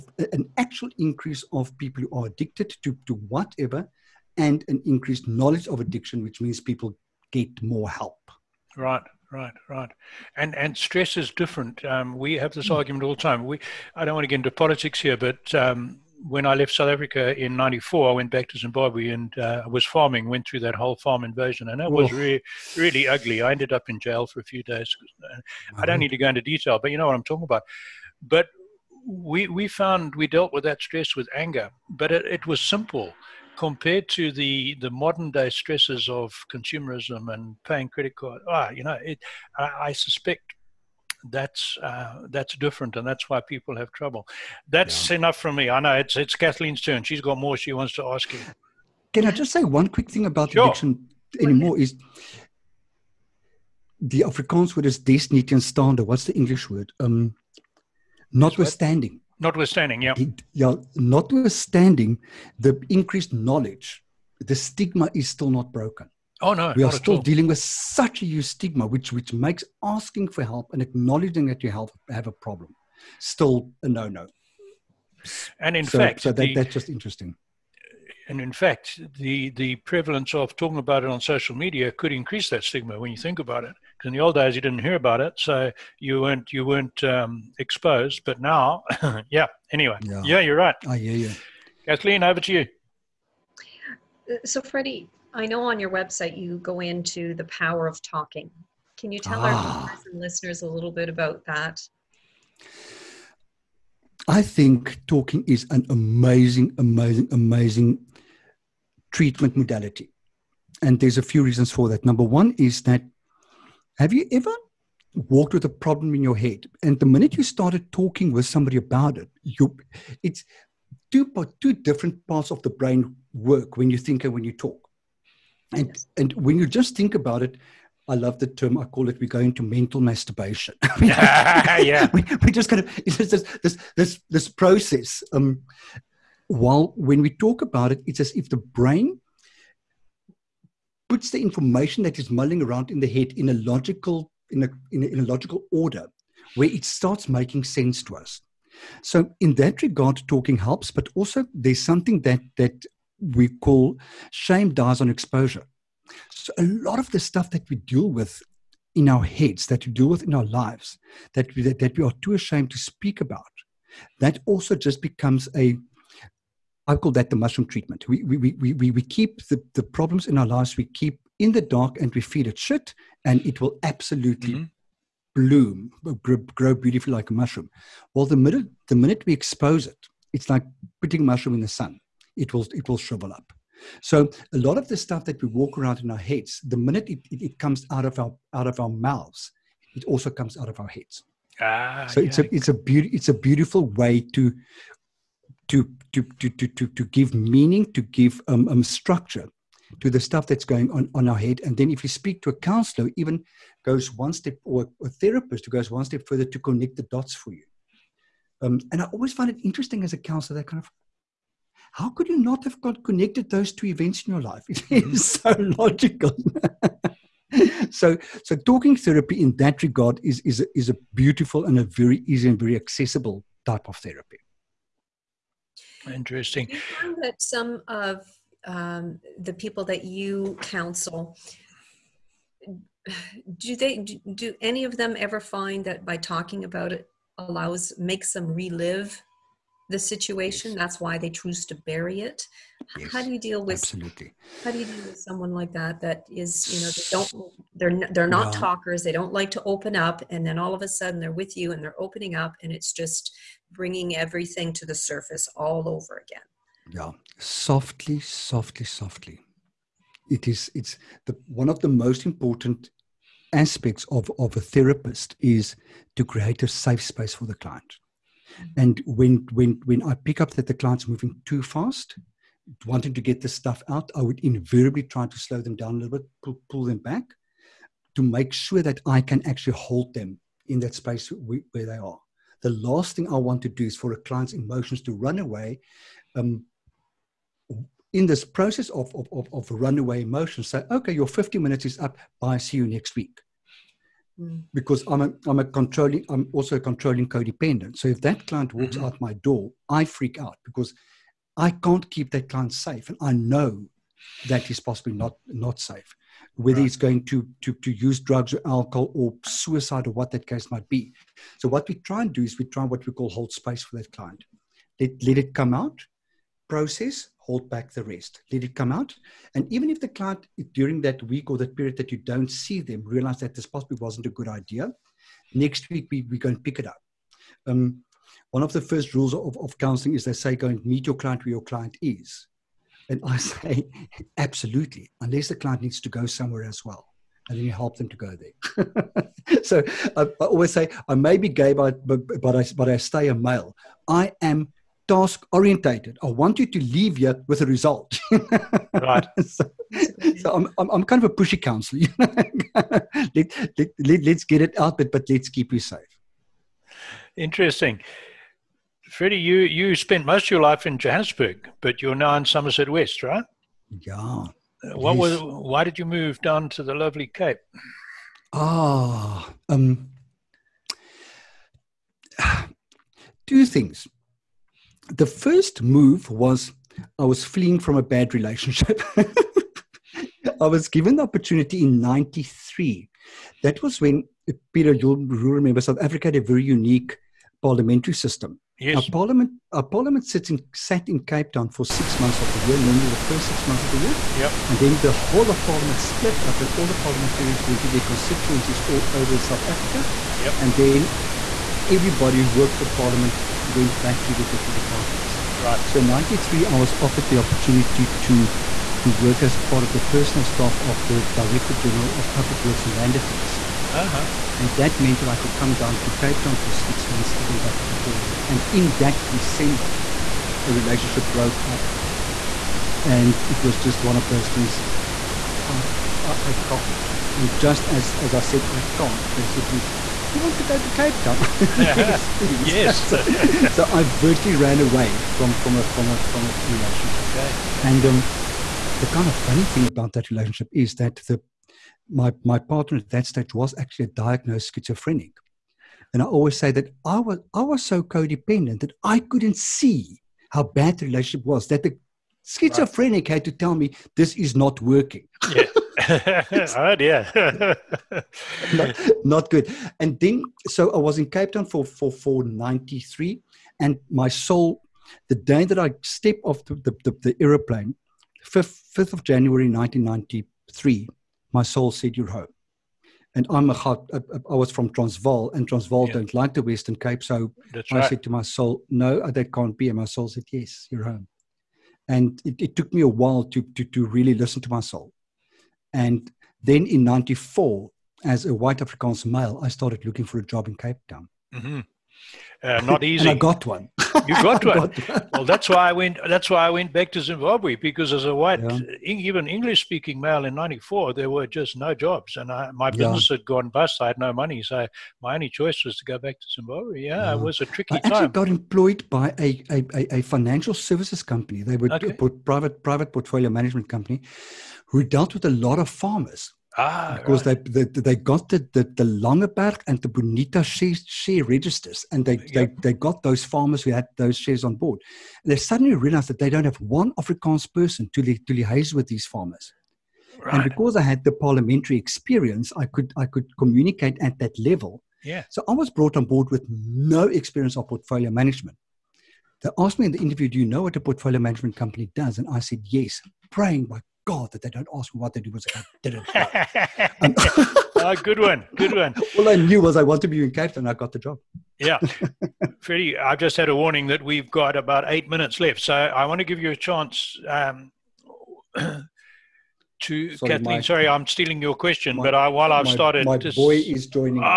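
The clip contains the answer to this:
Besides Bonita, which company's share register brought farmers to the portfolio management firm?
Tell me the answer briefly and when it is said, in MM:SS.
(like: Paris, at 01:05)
Langeberg, at 08:39.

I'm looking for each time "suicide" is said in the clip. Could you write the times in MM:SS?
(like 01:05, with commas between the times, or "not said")
05:09.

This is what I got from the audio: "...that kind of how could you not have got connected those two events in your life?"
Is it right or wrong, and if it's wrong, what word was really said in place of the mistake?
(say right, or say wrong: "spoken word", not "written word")
right.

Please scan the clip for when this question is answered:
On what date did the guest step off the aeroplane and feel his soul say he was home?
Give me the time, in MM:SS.
07:48.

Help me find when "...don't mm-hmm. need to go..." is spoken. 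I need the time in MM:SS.
00:25.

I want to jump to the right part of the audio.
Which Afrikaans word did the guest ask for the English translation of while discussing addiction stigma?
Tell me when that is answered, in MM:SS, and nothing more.
00:54.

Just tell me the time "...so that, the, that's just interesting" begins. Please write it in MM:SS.
01:16.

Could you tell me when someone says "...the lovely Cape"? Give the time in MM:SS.
06:06.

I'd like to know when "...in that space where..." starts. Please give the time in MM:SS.
04:40.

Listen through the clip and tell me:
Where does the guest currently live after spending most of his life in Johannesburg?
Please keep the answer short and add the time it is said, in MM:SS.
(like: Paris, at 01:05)
Somerset West, at 06:02.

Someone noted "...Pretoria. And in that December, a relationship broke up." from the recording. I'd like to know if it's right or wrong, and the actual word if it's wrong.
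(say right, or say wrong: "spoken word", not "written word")
right.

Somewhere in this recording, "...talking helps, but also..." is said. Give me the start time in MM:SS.
02:30.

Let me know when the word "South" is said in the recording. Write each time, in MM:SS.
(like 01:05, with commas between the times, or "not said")
00:16, 06:25, 06:39.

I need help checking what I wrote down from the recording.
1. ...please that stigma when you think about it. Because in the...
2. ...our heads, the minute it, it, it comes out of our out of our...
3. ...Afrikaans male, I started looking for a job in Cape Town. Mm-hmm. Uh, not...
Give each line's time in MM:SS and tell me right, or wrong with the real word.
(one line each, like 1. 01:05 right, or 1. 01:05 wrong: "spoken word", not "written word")
1. 01:22 wrong: "increase", not "please"
2. 03:06 right
3. 08:08 right.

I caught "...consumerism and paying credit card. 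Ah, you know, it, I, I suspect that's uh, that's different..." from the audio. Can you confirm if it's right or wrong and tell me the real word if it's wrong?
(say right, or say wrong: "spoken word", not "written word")
right.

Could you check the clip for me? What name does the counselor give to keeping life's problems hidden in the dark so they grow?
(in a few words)
the mushroom treatment.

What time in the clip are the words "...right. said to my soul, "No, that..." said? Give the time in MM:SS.
07:57.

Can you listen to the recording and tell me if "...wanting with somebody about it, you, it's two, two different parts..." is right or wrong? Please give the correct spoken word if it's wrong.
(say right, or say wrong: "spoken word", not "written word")
wrong: "talking", not "wanting".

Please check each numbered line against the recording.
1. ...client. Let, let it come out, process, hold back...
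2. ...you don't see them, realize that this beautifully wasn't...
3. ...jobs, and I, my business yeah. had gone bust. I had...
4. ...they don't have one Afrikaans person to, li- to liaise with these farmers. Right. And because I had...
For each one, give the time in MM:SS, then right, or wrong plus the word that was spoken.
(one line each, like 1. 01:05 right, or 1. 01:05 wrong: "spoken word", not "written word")
1. 05:14 right
2. 05:22 wrong: "possibly", not "beautifully"
3. 08:21 right
4. 08:46 right.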